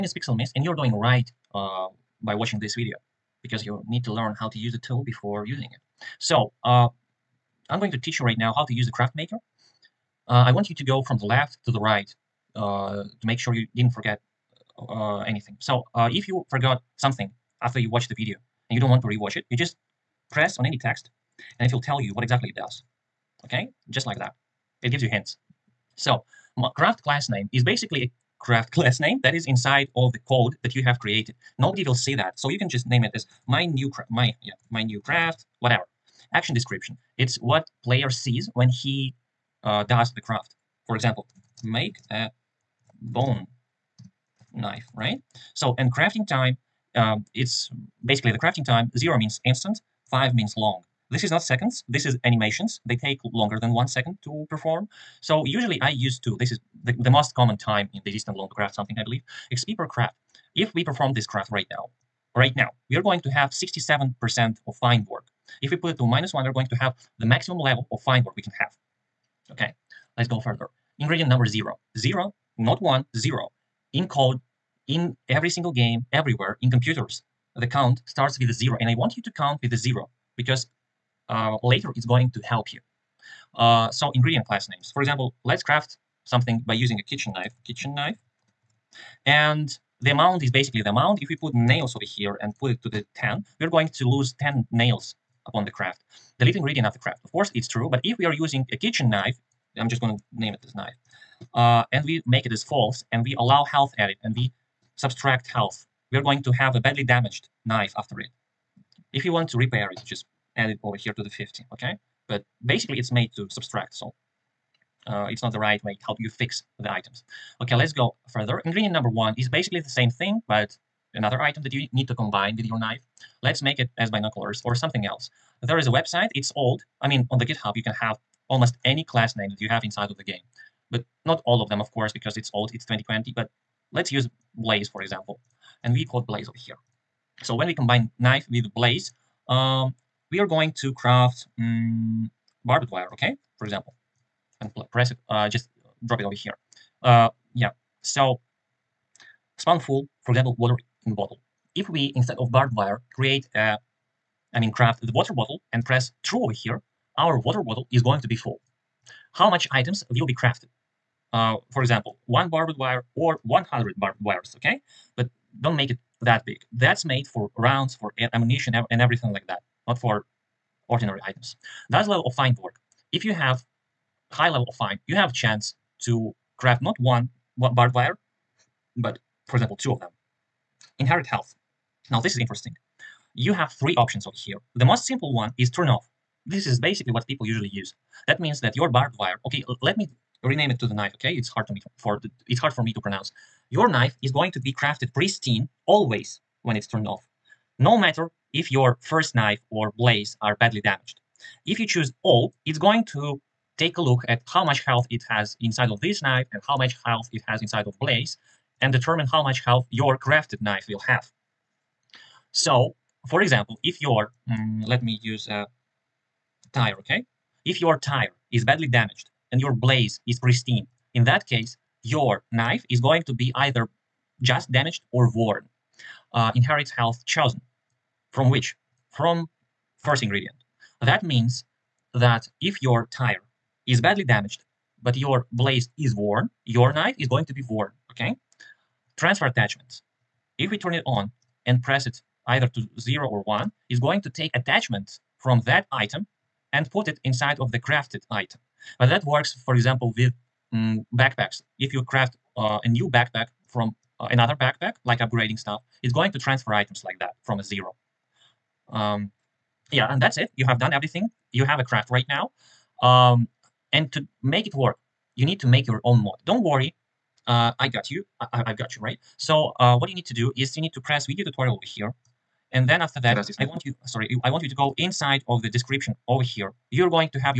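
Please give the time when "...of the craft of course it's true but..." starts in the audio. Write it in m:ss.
1:36.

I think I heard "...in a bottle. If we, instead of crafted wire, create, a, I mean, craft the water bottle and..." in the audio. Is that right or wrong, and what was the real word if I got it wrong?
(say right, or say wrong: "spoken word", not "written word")
wrong: "barbed", not "crafted".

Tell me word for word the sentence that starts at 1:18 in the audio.
And I want you to count with the zero because uh, later it's going to help you.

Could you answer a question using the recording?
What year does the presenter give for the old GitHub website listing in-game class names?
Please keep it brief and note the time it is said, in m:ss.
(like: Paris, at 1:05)
2020, at 2:12.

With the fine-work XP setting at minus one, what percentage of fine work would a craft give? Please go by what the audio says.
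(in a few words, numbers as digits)
67%.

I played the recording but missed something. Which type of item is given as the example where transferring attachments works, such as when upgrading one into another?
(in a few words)
Backpacks.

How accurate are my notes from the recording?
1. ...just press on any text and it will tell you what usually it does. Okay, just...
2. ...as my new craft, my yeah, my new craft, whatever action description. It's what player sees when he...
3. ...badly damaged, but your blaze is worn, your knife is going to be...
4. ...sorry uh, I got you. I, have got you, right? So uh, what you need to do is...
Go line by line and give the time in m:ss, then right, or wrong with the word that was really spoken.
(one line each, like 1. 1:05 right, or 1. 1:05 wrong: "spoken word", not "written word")
1. 0:19 wrong: "exactly", not "usually"
2. 0:33 right
3. 3:54 right
4. 4:26 wrong: "worry", not "sorry".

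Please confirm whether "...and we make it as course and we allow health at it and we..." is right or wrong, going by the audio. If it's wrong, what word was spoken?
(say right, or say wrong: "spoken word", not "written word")
wrong: "false", not "course".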